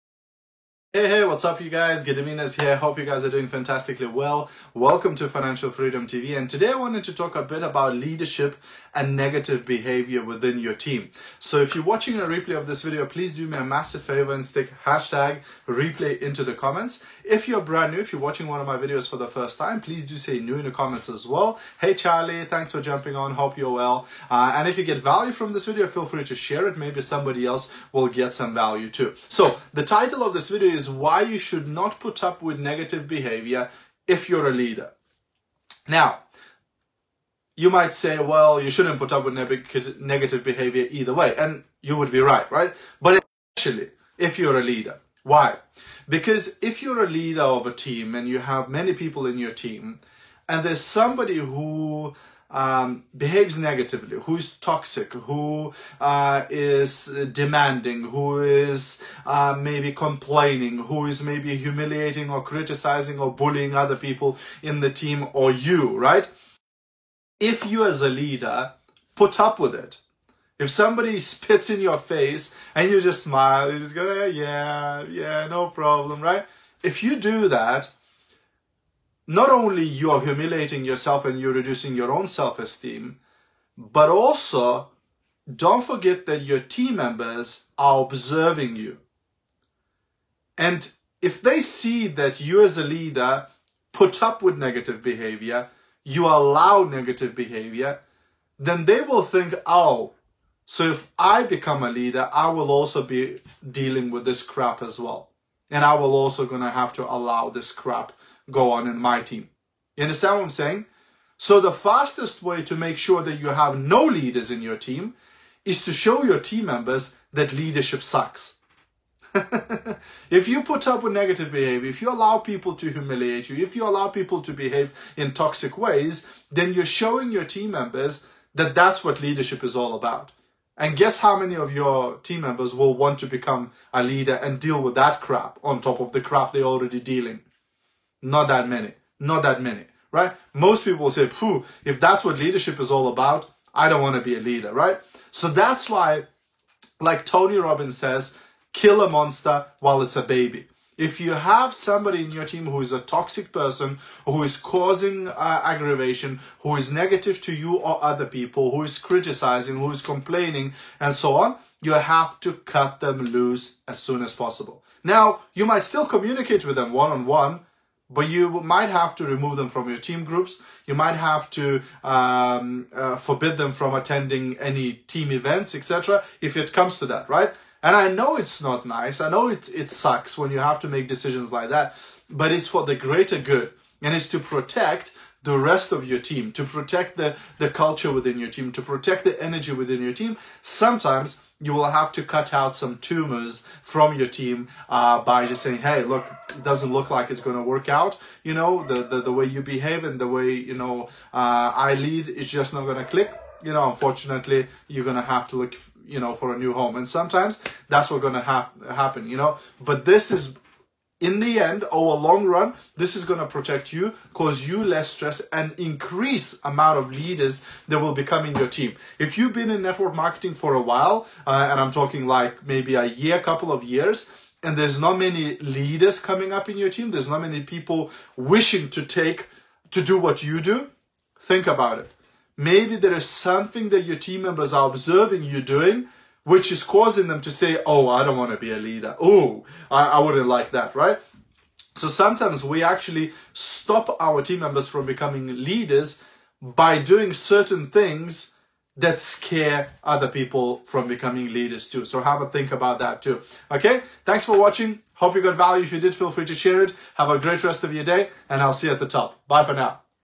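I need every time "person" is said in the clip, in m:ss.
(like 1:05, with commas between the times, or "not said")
2:33.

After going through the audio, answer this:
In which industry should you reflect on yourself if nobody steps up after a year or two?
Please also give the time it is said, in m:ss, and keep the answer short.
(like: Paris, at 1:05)
network marketing, at 3:39.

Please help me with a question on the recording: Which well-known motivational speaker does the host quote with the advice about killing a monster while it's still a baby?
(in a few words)
Tony Robbins.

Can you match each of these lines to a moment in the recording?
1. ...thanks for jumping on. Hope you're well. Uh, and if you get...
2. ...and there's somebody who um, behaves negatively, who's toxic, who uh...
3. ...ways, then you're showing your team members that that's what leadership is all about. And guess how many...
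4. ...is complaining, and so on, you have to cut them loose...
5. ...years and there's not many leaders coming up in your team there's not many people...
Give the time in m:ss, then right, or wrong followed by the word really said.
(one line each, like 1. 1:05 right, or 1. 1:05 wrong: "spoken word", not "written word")
1. 0:22 right
2. 0:50 right
3. 2:05 right
4. 2:39 right
5. 3:43 right.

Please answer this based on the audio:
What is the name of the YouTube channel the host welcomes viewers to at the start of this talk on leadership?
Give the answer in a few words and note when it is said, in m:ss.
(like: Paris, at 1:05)
Financial Freedom TV, at 0:05.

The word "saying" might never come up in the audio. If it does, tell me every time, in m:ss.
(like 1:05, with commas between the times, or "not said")
1:50, 3:15.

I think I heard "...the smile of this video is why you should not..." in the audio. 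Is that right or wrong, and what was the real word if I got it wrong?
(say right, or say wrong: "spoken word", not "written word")
wrong: "title", not "smile".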